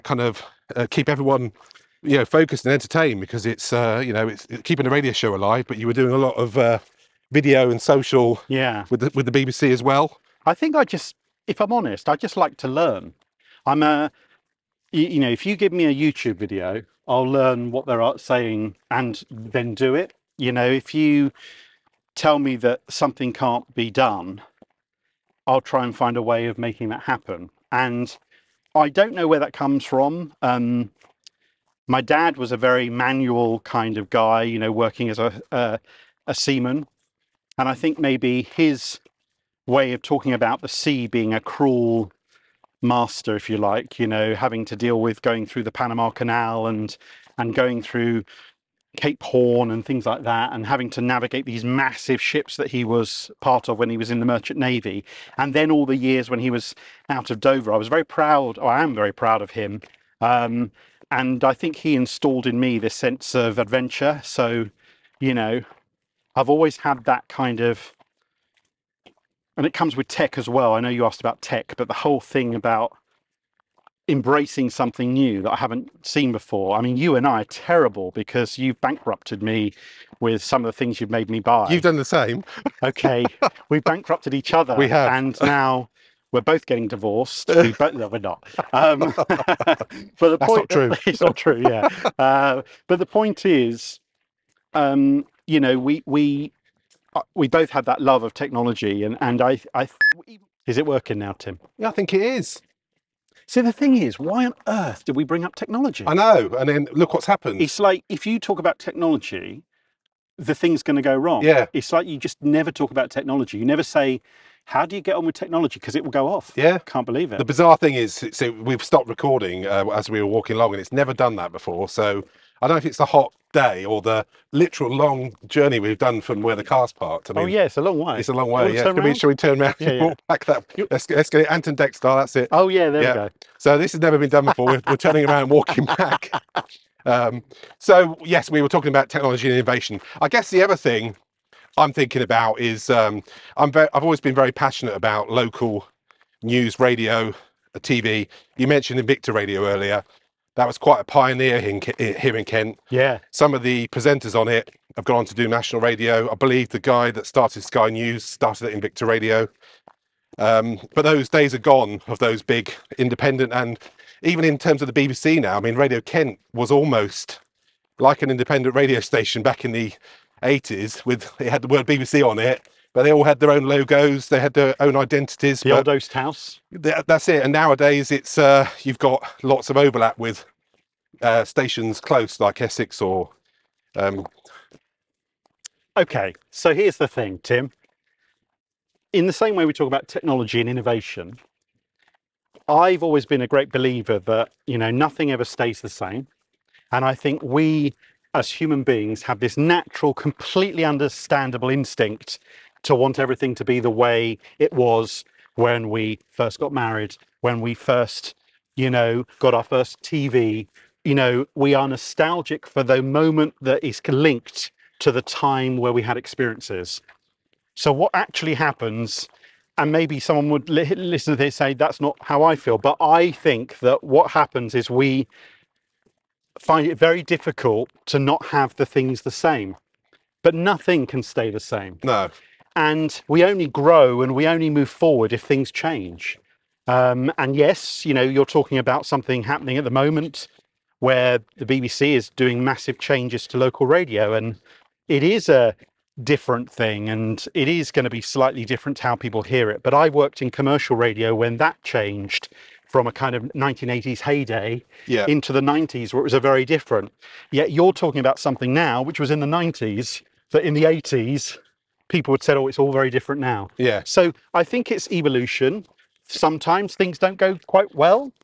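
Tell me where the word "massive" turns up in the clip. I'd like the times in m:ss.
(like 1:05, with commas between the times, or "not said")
0:51, 4:02.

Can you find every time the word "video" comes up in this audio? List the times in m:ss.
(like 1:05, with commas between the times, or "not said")
0:07, 0:16.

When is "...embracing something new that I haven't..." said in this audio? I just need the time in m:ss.
1:14.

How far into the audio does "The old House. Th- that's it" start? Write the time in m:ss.
2:55.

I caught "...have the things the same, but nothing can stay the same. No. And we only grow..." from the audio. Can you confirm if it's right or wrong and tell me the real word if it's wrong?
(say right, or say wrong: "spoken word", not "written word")
right.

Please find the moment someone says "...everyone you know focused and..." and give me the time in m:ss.
0:01.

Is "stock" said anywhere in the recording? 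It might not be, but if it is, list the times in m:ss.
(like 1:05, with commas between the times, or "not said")
not said.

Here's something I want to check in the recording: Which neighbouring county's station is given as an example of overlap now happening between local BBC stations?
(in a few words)
Essex.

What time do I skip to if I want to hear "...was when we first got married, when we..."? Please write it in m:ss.
3:24.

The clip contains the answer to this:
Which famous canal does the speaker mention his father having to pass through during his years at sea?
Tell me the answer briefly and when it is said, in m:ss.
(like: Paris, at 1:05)
Panama Canal, at 0:45.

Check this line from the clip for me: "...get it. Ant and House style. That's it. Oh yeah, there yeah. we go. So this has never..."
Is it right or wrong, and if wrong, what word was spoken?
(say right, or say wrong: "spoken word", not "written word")
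wrong: "Dec", not "House".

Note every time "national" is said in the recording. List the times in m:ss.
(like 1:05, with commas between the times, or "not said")
2:35.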